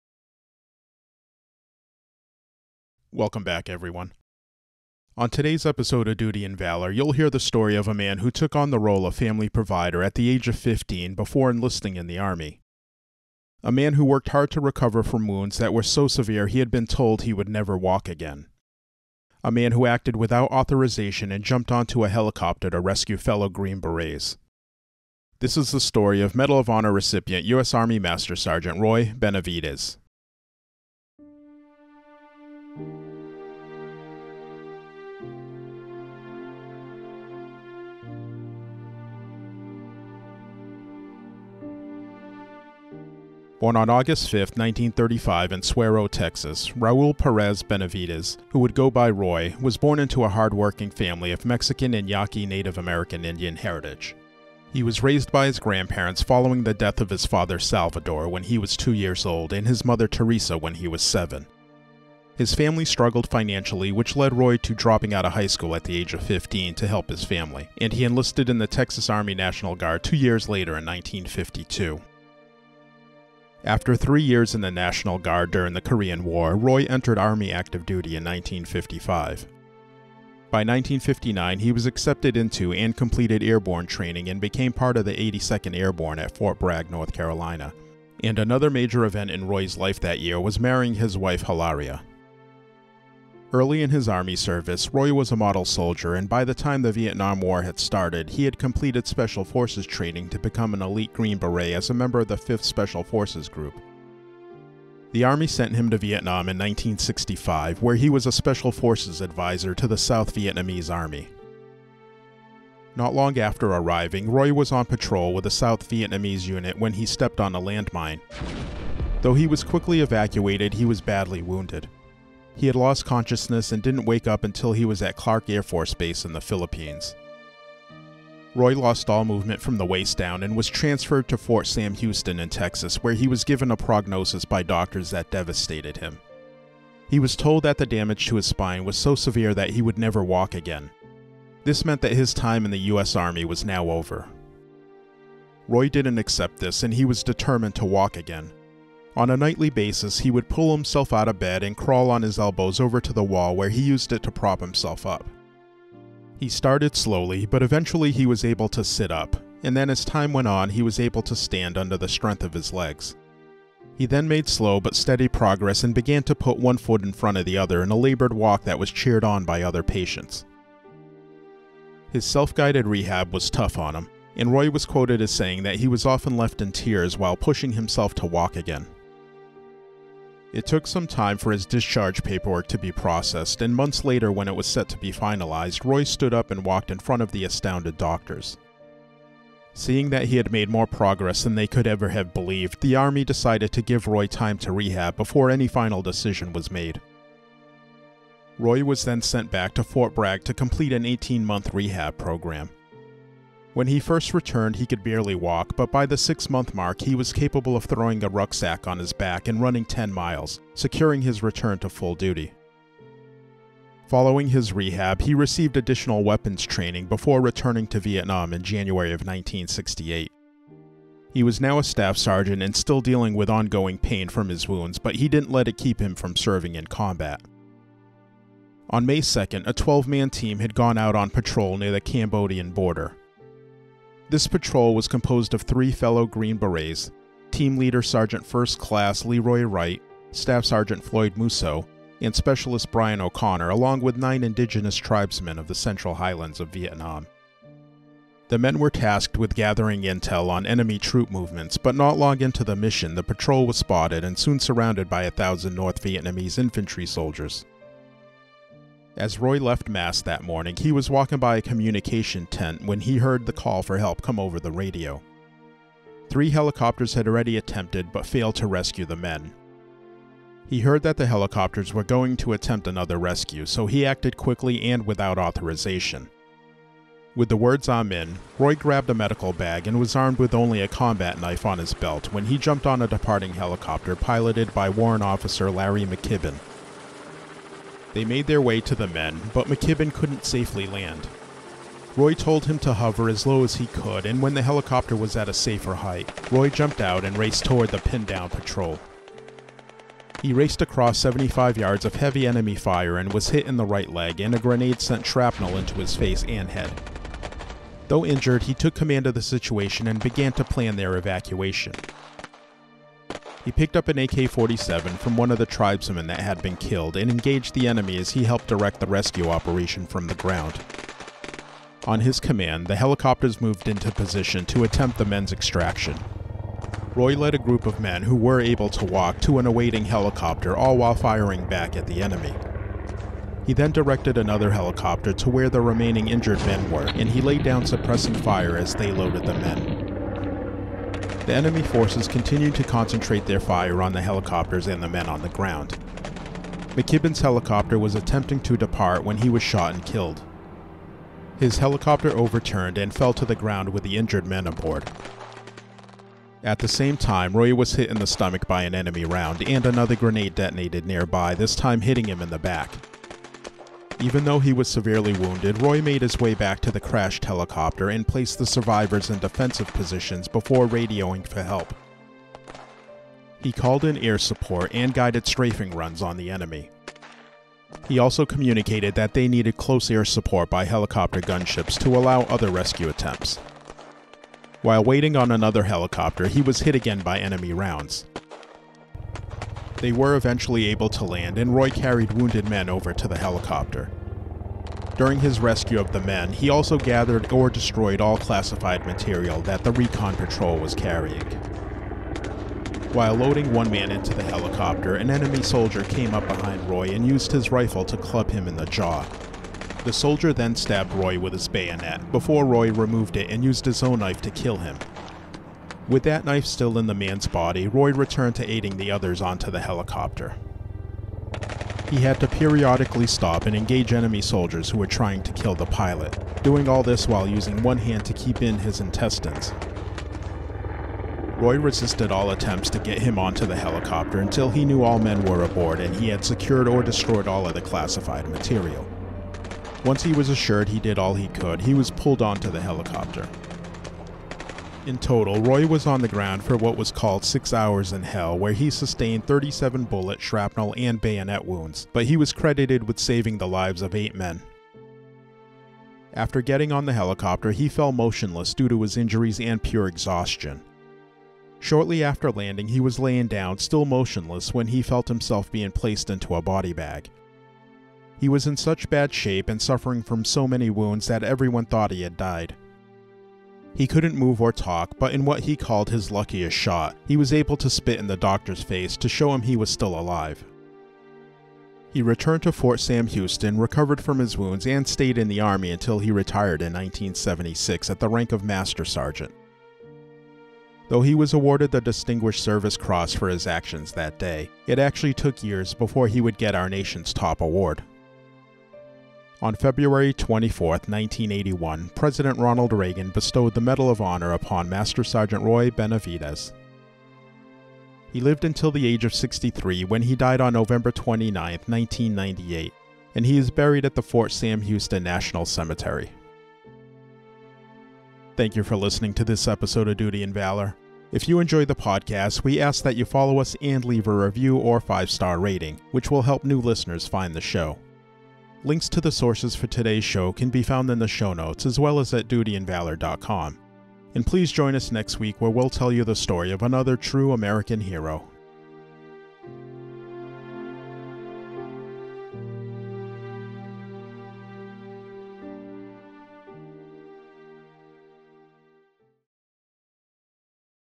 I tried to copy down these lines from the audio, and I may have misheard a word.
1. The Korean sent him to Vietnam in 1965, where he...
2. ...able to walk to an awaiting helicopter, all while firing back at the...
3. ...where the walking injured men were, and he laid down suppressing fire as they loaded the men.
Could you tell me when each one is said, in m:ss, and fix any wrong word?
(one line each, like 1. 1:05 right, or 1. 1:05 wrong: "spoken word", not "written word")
1. 1:45 wrong: "Army", not "Korean"
2. 5:28 right
3. 5:35 wrong: "remaining", not "walking".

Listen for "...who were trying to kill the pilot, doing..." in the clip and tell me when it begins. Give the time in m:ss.
7:04.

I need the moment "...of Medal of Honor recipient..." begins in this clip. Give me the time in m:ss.
0:26.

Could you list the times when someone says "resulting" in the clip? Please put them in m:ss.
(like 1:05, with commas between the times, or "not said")
not said.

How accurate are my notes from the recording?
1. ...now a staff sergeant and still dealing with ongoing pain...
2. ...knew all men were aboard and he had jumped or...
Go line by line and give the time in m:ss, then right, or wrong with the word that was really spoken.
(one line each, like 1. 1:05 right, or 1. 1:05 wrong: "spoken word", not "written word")
1. 3:41 right
2. 7:14 wrong: "secured", not "jumped".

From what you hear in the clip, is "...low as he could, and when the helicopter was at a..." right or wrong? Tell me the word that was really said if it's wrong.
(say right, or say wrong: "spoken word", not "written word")
right.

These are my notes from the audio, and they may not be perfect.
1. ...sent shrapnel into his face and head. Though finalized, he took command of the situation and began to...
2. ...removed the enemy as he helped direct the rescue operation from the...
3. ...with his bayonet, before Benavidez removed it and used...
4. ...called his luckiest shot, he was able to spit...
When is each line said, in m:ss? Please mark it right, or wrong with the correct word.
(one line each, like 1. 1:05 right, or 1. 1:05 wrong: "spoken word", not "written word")
1. 5:04 wrong: "injured", not "finalized"
2. 5:17 wrong: "engaged", not "removed"
3. 6:51 wrong: "Roy", not "Benavidez"
4. 7:55 right.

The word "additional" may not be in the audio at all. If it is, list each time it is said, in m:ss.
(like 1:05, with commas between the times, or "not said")
3:35.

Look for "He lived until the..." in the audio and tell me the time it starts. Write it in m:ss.
8:28.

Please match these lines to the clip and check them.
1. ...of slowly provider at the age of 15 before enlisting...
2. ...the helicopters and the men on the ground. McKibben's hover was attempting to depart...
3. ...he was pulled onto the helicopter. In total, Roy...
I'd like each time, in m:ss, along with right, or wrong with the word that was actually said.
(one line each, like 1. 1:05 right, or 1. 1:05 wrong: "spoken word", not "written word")
1. 0:09 wrong: "family", not "slowly"
2. 5:44 wrong: "helicopter", not "hover"
3. 7:21 right.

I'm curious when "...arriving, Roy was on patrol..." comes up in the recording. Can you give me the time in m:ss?
1:53.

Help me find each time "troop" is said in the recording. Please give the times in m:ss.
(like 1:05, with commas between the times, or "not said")
4:10.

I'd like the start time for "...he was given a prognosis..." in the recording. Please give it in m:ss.
2:13.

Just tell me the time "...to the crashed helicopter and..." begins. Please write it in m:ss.
6:06.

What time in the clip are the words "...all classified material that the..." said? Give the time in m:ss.
6:38.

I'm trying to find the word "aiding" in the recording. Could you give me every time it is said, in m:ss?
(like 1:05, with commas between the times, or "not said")
6:58.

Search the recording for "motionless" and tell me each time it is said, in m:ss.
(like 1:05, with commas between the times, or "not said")
7:38, 7:44.